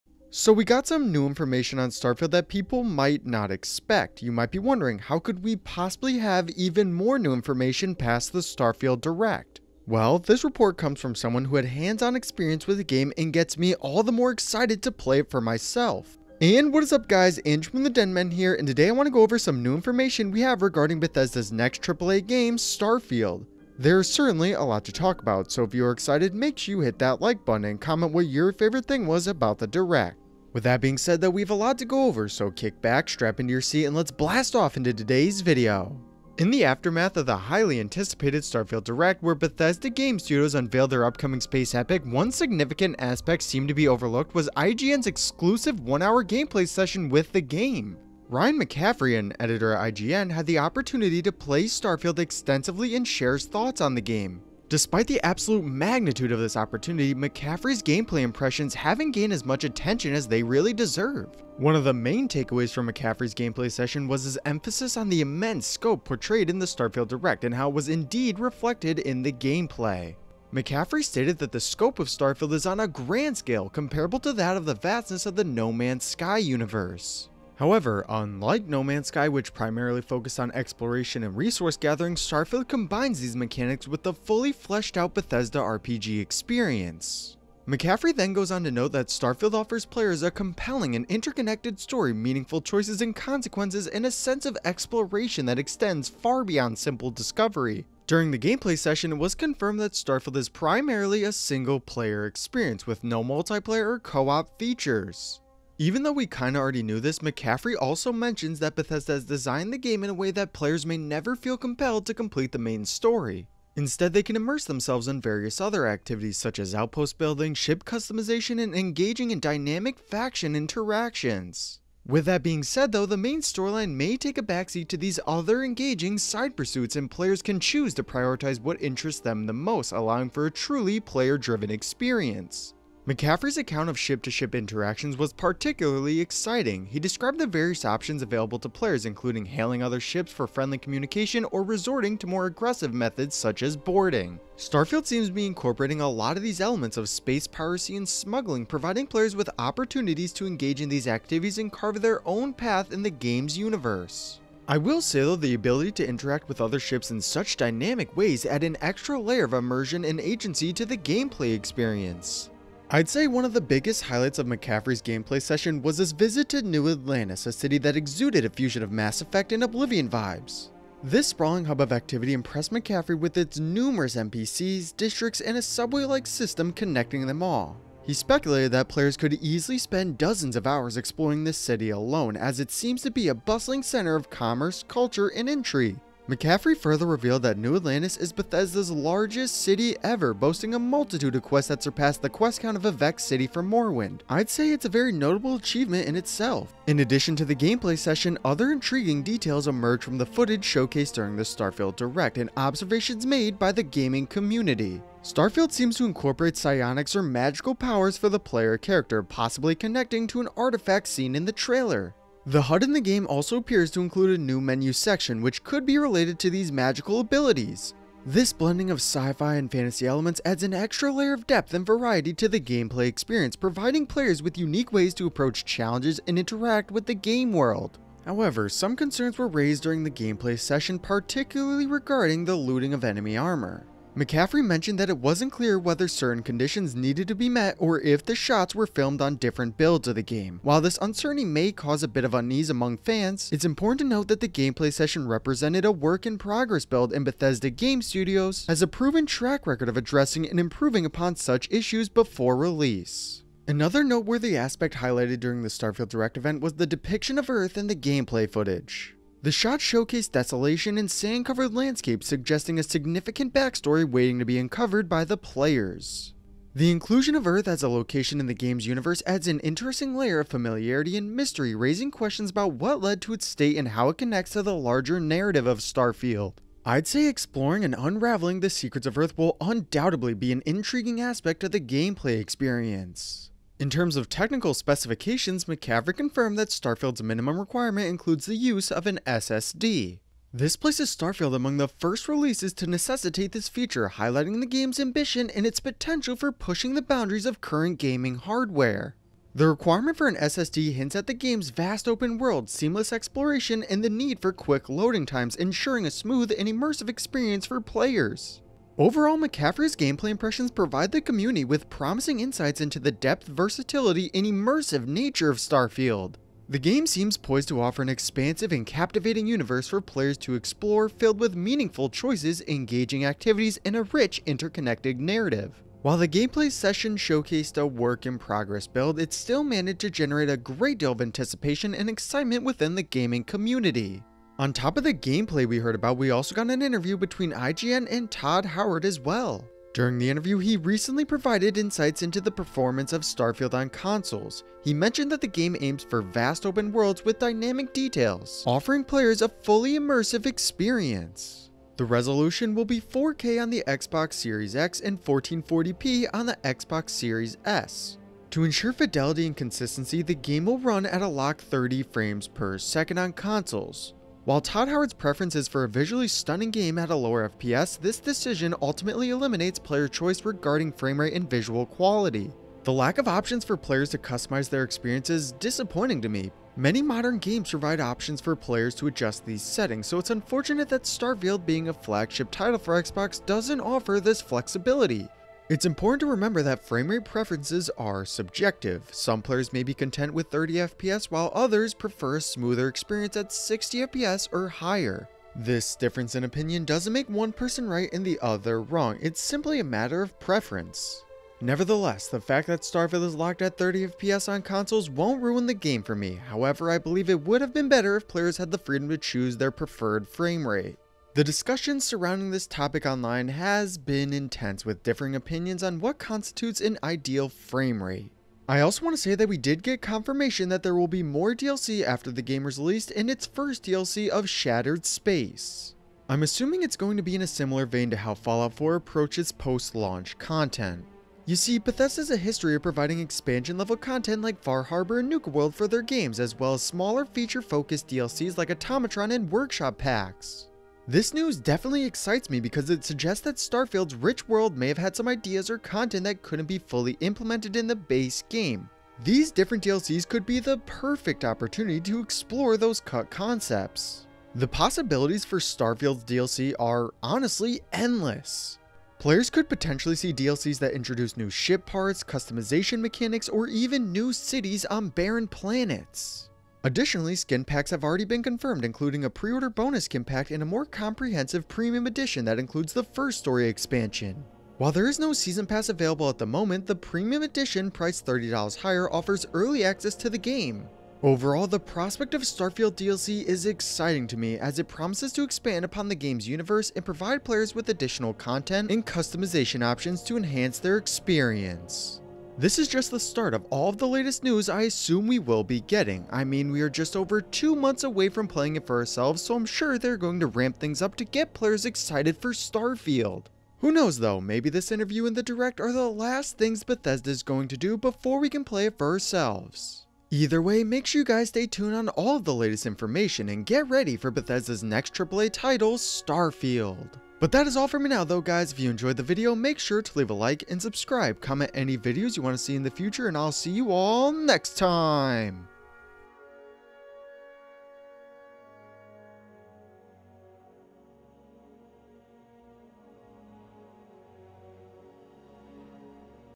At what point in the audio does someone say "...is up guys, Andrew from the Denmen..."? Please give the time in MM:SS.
00:16.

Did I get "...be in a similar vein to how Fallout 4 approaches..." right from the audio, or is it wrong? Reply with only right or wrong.
right.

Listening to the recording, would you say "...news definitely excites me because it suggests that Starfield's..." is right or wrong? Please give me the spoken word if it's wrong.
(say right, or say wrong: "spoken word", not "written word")
right.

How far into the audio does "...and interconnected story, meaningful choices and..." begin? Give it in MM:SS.
01:30.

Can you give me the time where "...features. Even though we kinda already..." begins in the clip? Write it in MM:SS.
01:44.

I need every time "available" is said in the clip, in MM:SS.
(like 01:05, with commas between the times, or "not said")
02:18, 07:55.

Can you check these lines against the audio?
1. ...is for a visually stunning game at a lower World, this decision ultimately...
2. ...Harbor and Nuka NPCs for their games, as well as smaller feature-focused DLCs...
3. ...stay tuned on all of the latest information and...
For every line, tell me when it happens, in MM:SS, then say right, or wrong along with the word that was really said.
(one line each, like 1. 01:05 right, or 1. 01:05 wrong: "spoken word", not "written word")
1. 06:05 wrong: "FPS", not "World"
2. 07:14 wrong: "World", not "NPCs"
3. 08:31 right.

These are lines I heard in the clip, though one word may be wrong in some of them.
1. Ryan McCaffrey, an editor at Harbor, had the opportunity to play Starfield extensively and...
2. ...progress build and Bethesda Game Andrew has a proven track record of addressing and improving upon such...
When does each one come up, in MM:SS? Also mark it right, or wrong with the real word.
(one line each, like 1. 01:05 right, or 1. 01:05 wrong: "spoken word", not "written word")
1. 00:48 wrong: "IGN", not "Harbor"
2. 04:06 wrong: "Studios", not "Andrew".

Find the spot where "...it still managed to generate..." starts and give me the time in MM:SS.
05:29.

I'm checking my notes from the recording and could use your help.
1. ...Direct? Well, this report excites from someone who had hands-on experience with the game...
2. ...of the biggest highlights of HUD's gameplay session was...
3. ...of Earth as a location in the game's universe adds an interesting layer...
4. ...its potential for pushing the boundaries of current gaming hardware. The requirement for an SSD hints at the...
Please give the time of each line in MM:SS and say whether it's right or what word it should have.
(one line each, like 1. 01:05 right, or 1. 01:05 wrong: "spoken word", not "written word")
1. 00:09 wrong: "comes", not "excites"
2. 02:43 wrong: "McCaffrey", not "HUD"
3. 04:27 right
4. 04:55 right.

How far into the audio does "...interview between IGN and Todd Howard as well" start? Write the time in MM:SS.
05:36.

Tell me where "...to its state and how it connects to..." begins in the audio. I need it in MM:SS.
04:33.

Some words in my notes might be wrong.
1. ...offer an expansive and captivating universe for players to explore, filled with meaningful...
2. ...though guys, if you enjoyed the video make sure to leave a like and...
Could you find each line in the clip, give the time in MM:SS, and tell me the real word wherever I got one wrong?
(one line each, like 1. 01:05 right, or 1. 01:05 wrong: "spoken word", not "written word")
1. 05:17 right
2. 08:38 right.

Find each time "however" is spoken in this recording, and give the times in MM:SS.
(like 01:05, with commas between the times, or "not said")
01:17, 03:48, 06:46.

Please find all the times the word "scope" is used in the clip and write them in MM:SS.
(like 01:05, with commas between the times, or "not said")
01:05, 01:11.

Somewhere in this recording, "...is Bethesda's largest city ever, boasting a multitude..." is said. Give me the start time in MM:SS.
03:08.